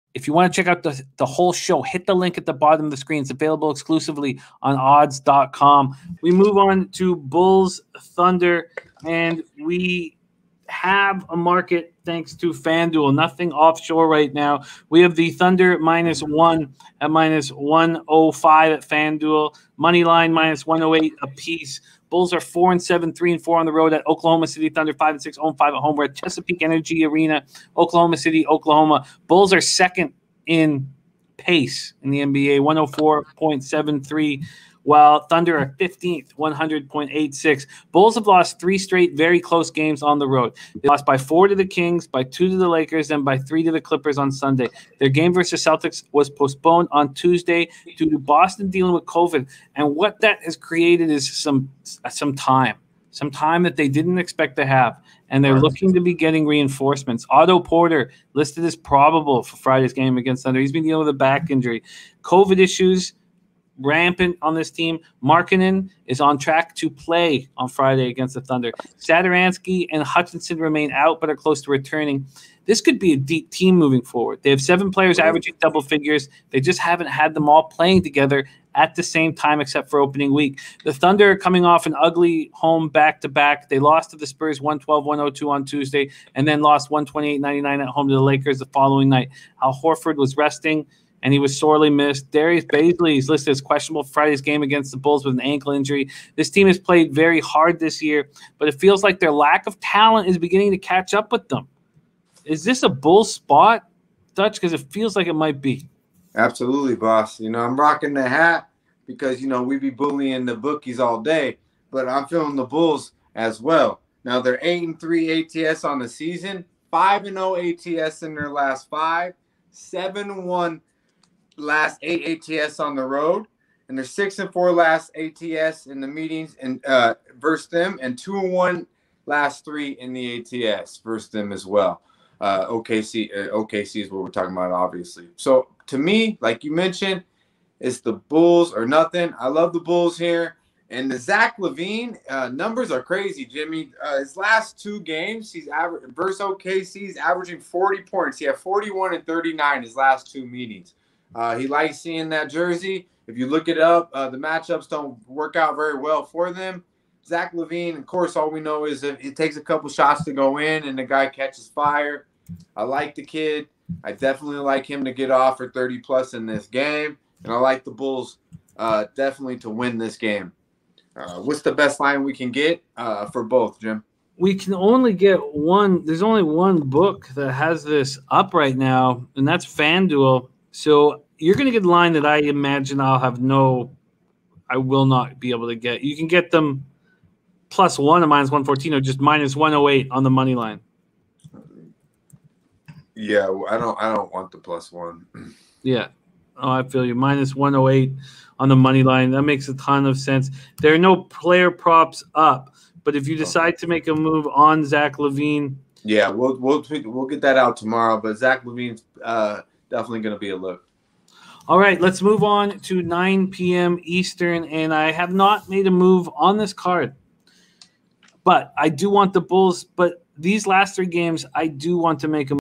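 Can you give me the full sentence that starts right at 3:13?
Yeah, I don't, I don't want the plus one.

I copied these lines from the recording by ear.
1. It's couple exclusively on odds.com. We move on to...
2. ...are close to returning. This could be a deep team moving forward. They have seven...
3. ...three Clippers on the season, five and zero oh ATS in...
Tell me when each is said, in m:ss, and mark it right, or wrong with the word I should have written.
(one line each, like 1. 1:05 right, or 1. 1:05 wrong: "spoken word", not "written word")
1. 0:03 wrong: "available", not "couple"
2. 1:11 right
3. 1:54 wrong: "ATS", not "Clippers".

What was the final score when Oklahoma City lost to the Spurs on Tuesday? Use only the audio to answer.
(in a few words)
112-102.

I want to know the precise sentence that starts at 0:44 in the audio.
Their game versus Celtics was postponed on Tuesday due to Boston dealing with COVID.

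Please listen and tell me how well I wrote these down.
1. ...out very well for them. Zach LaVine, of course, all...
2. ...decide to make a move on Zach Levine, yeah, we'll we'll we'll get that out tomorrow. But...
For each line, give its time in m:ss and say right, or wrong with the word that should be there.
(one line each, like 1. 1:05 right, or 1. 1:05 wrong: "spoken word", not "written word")
1. 2:35 right
2. 3:23 right.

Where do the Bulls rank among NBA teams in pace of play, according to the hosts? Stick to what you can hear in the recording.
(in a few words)
2nd.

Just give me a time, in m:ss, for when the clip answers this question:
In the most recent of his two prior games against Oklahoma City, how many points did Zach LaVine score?
2:29.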